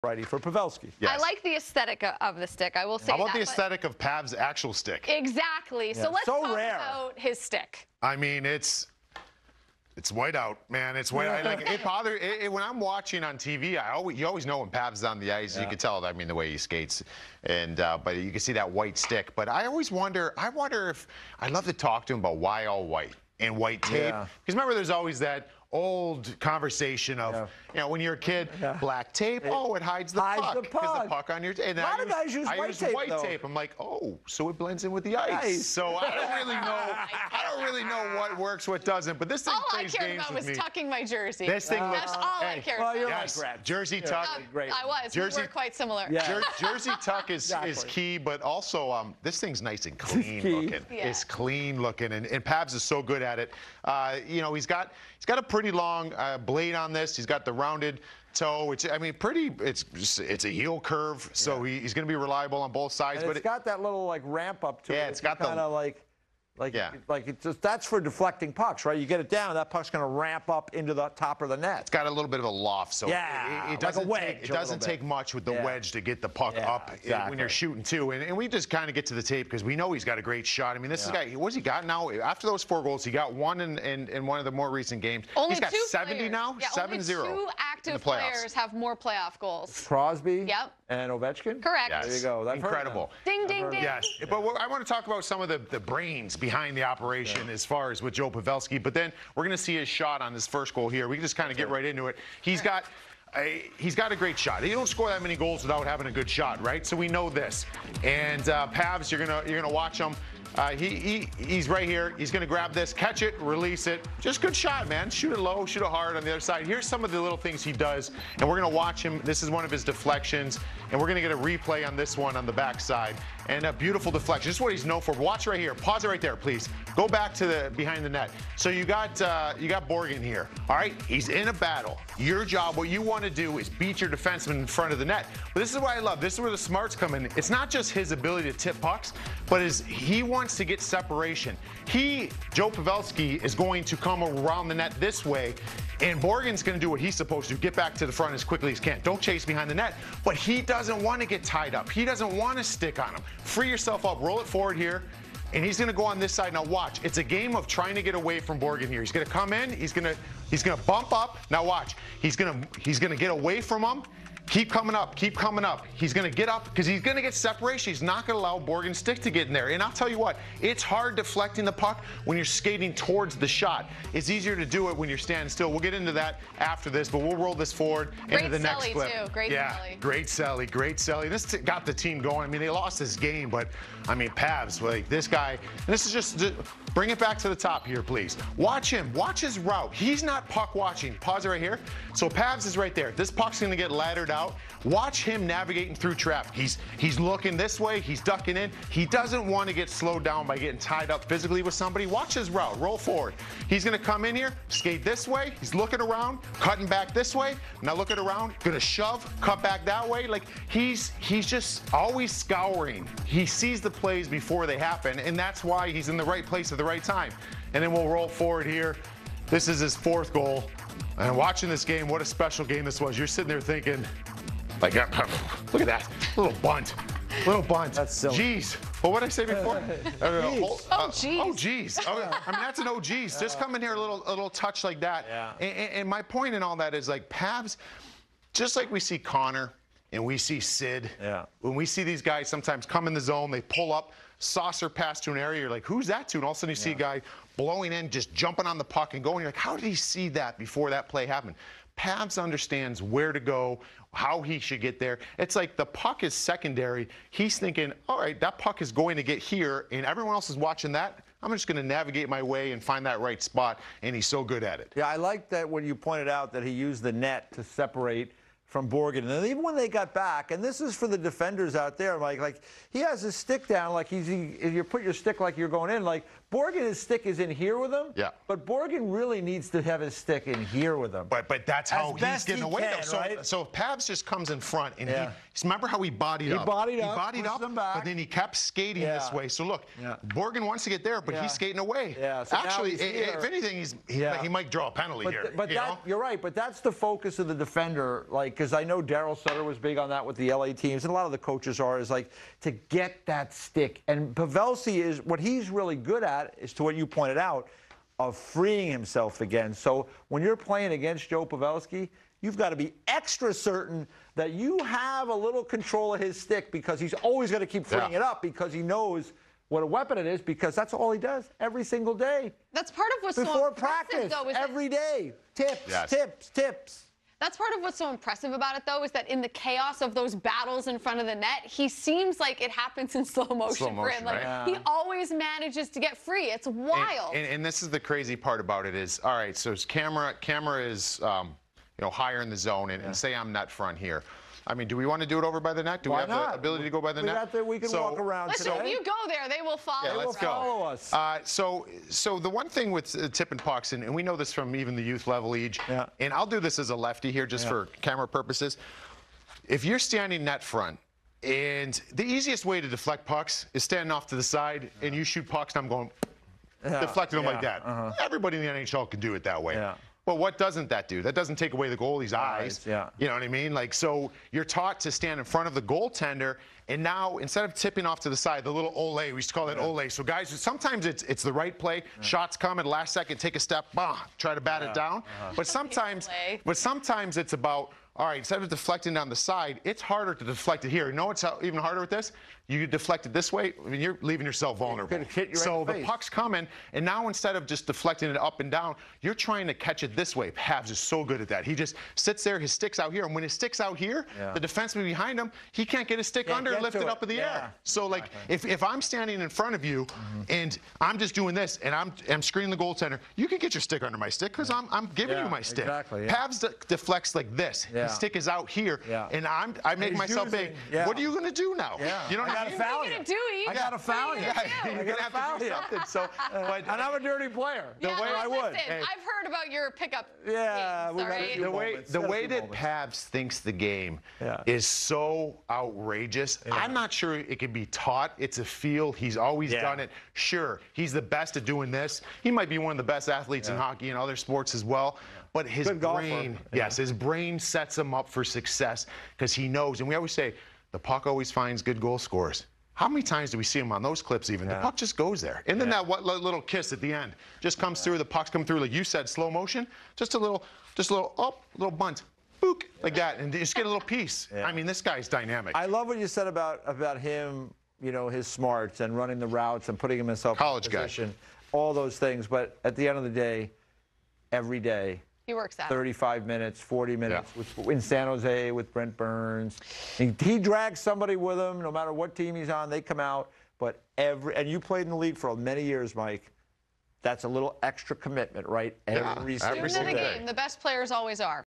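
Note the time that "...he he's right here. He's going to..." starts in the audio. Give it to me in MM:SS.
01:50.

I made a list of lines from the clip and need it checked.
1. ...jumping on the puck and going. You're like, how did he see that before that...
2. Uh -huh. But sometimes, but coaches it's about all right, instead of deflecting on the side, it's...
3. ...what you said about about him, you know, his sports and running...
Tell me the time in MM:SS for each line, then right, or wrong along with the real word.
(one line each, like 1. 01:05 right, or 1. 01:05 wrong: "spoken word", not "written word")
1. 04:08 right
2. 06:25 wrong: "sometimes", not "coaches"
3. 07:46 wrong: "smarts", not "sports".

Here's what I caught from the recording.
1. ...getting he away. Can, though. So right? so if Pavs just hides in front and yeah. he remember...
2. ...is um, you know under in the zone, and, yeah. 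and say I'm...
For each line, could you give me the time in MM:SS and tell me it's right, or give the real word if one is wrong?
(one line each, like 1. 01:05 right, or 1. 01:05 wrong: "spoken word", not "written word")
1. 04:42 wrong: "comes", not "hides"
2. 05:40 wrong: "higher", not "under".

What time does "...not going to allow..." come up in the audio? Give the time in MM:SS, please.
02:48.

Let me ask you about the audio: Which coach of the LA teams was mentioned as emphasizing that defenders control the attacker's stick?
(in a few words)
Daryl Sutter.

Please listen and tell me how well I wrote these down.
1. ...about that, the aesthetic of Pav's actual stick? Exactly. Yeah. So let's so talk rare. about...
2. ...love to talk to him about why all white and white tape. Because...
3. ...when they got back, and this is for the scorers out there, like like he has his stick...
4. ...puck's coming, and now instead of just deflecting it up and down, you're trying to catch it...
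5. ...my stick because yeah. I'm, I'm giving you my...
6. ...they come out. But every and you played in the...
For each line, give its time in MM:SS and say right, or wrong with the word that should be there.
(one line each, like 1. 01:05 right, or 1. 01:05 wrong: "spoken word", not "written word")
1. 00:03 right
2. 00:21 right
3. 04:29 wrong: "defenders", not "scorers"
4. 06:36 right
5. 06:54 right
6. 08:02 right.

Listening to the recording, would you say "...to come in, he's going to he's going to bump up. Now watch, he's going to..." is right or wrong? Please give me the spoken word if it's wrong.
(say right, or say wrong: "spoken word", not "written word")
right.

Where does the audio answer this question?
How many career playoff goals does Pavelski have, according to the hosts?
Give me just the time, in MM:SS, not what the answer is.
01:26.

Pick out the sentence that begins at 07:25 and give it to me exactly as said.
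But his Good brain, yes, his brain sets him up for success because he knows.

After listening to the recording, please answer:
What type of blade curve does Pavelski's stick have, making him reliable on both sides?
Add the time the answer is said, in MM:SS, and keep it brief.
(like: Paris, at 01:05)
Heel curve, at 01:00.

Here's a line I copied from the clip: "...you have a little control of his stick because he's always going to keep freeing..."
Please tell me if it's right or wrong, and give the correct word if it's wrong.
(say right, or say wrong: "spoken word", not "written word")
right.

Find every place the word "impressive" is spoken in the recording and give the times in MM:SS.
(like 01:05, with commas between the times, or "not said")
05:28.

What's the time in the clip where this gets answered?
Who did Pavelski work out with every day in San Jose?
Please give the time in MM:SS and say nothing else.
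07:58.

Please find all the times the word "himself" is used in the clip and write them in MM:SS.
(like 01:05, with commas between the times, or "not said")
05:08, 07:50.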